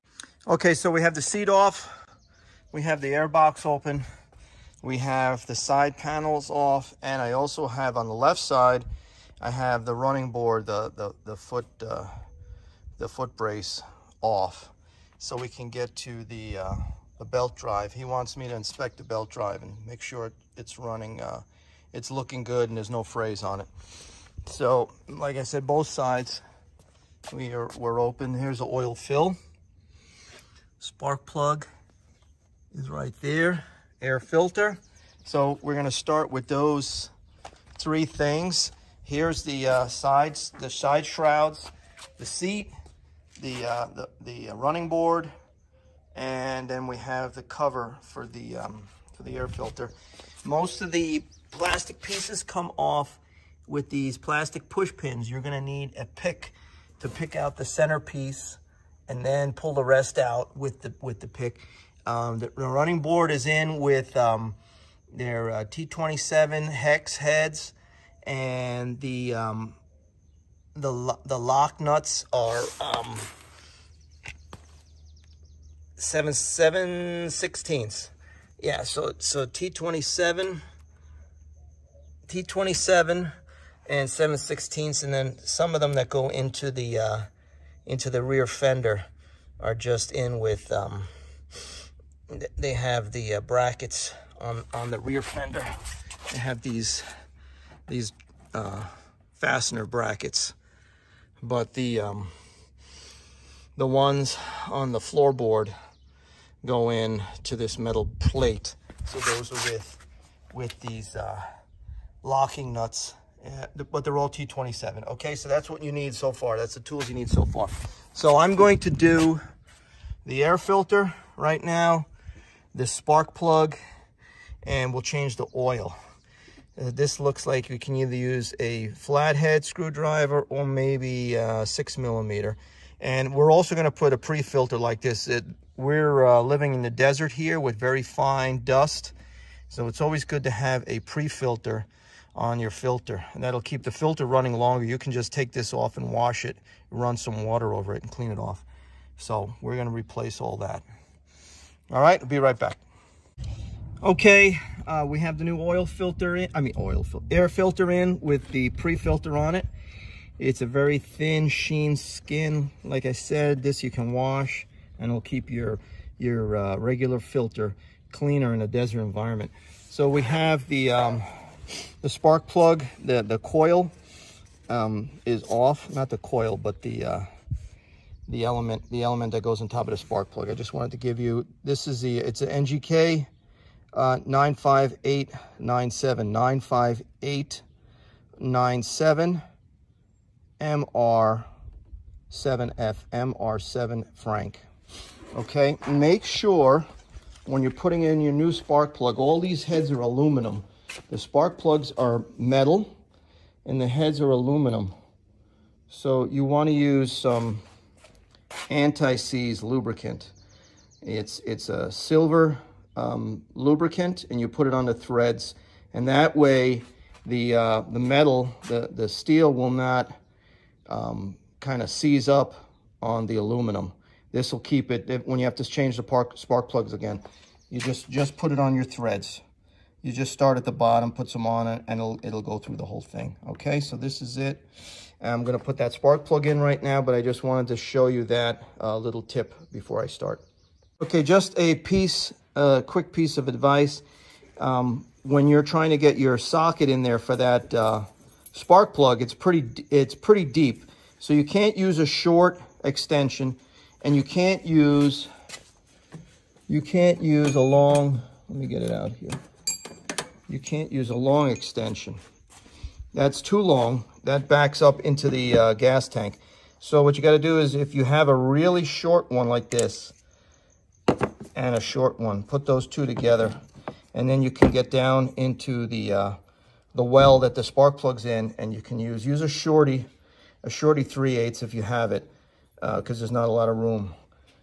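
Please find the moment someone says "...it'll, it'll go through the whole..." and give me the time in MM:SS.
03:52.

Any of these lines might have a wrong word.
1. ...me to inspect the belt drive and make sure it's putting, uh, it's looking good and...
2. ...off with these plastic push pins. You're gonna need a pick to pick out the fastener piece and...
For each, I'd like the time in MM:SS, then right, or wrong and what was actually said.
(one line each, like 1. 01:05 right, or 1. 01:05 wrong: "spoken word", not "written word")
1. 00:18 wrong: "running", not "putting"
2. 00:52 wrong: "center", not "fastener".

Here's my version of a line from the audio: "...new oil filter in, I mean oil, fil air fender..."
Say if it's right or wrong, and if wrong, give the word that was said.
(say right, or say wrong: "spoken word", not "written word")
wrong: "filter", not "fender".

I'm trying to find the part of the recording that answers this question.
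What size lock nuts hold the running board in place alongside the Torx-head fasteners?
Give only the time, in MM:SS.
01:15.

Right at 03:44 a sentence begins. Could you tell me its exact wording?
This will keep it, when you have to change the park, spark plugs again, you just, just put it on your threads.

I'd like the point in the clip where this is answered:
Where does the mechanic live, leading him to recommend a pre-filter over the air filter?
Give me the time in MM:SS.
02:16.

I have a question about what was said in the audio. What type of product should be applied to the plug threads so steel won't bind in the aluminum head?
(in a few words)
anti-seize lubricant.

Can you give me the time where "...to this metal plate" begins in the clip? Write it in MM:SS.
01:47.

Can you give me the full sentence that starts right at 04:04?
Um, when you're trying to get your socket in there for that uh, spark plug, it's pretty, it's pretty deep.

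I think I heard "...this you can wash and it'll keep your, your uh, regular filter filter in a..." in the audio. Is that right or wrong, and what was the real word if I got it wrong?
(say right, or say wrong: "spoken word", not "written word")
wrong: "cleaner", not "filter".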